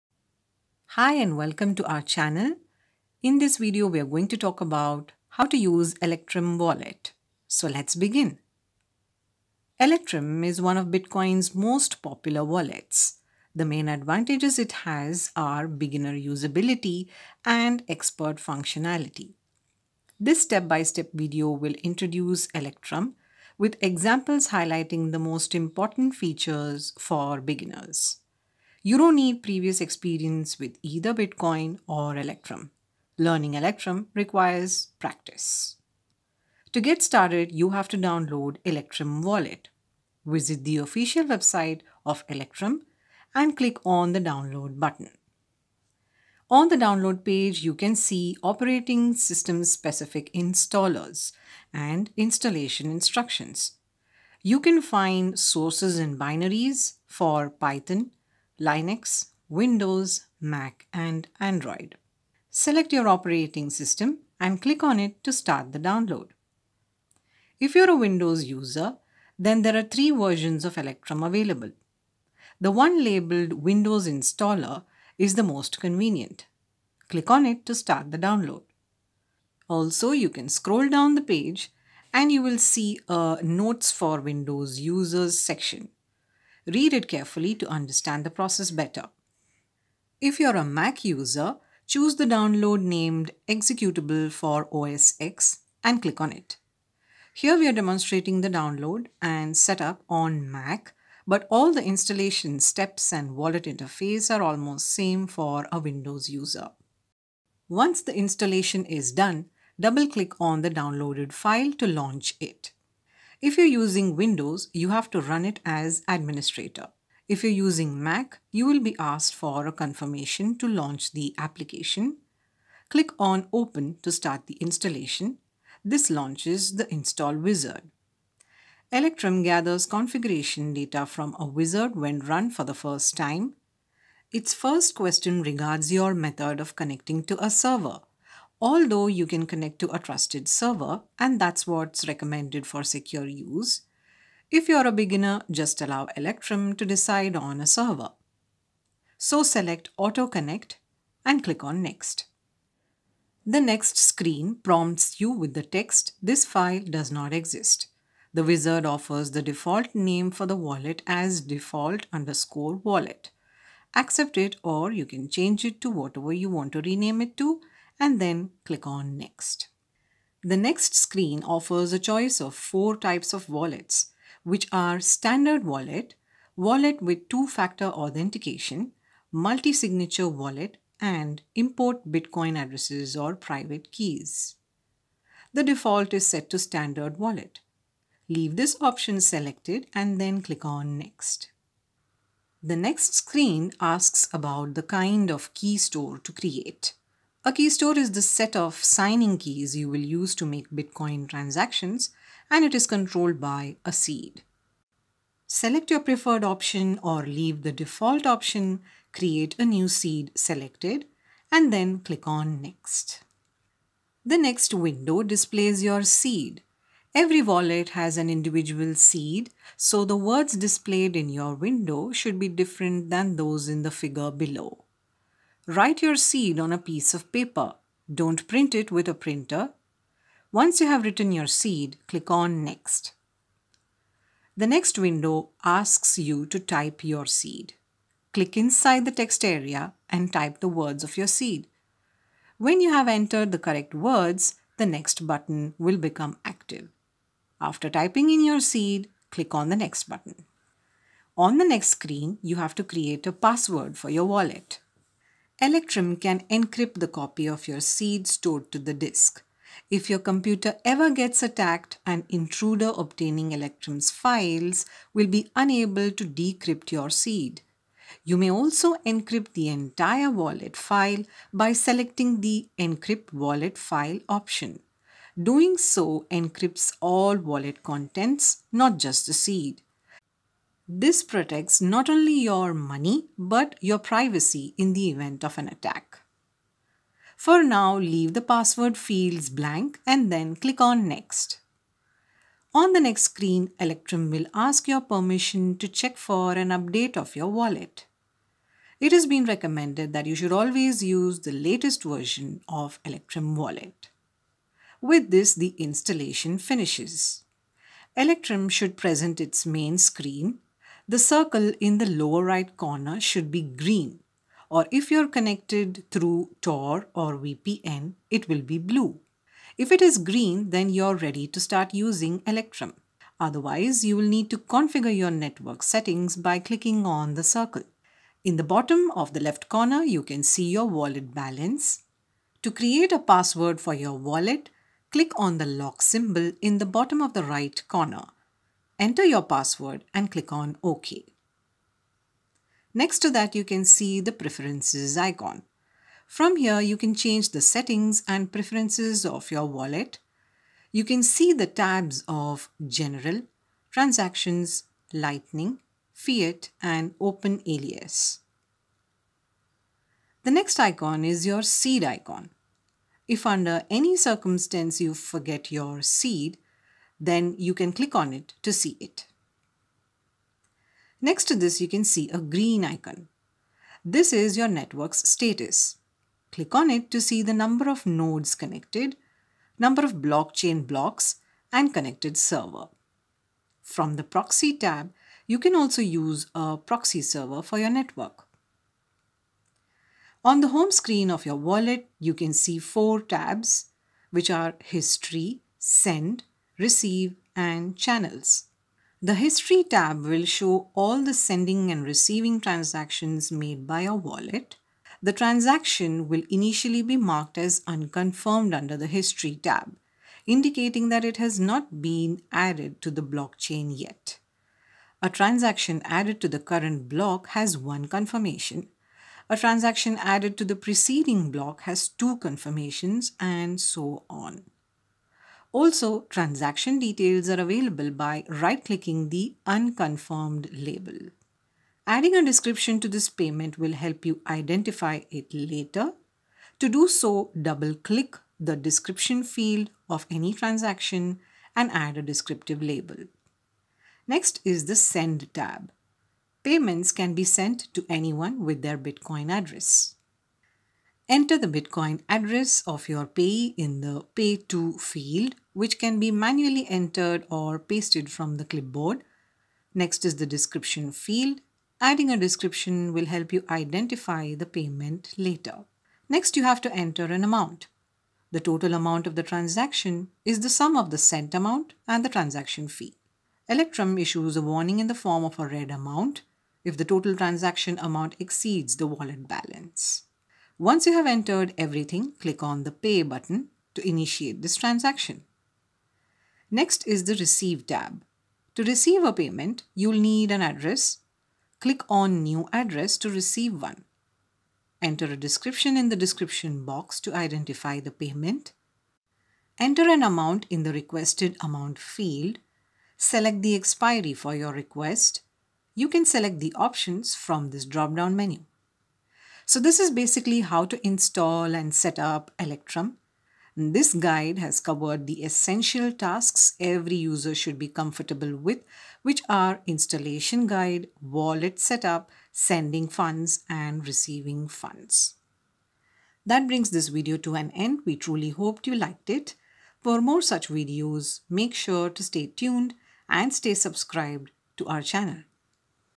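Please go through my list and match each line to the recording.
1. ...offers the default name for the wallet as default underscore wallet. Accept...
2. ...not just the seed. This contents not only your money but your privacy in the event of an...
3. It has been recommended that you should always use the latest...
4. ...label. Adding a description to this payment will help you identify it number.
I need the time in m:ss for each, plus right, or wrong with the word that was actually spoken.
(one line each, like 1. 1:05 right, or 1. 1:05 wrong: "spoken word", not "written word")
1. 2:38 right
2. 4:38 wrong: "protects", not "contents"
3. 4:58 right
4. 7:10 wrong: "later", not "number".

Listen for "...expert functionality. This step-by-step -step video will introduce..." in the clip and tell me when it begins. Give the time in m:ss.
0:17.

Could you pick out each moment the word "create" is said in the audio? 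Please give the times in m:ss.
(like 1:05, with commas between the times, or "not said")
3:16, 3:29, 4:12, 5:32.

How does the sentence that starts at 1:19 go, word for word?
Also, you can scroll down the page and you will see a Notes for Windows Users section.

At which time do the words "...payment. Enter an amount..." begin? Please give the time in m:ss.
8:18.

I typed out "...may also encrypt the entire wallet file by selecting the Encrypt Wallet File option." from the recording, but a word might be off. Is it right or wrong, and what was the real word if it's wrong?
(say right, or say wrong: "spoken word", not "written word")
right.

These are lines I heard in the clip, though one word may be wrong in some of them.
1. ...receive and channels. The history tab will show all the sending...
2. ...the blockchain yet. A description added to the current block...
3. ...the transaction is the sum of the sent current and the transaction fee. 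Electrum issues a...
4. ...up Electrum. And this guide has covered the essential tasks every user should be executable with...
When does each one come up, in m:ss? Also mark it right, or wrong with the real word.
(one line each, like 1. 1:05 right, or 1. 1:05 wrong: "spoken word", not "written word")
1. 6:36 right
2. 6:53 wrong: "transaction", not "description"
3. 7:49 wrong: "amount", not "current"
4. 8:32 wrong: "comfortable", not "executable".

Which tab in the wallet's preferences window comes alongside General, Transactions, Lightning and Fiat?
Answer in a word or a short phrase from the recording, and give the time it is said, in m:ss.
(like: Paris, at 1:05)
Open Alias, at 5:57.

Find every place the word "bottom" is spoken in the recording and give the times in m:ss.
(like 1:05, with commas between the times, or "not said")
5:28, 5:36.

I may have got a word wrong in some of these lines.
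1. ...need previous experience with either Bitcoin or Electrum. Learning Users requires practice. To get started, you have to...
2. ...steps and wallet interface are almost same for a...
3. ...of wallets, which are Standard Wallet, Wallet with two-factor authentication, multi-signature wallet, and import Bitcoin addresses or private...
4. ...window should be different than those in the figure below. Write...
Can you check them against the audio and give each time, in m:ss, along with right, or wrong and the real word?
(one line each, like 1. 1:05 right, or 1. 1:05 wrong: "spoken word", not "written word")
1. 0:29 wrong: "Electrum", not "Users"
2. 1:42 right
3. 2:53 right
4. 3:41 right.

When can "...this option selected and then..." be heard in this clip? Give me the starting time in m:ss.
3:08.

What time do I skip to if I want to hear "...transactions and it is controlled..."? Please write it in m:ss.
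3:21.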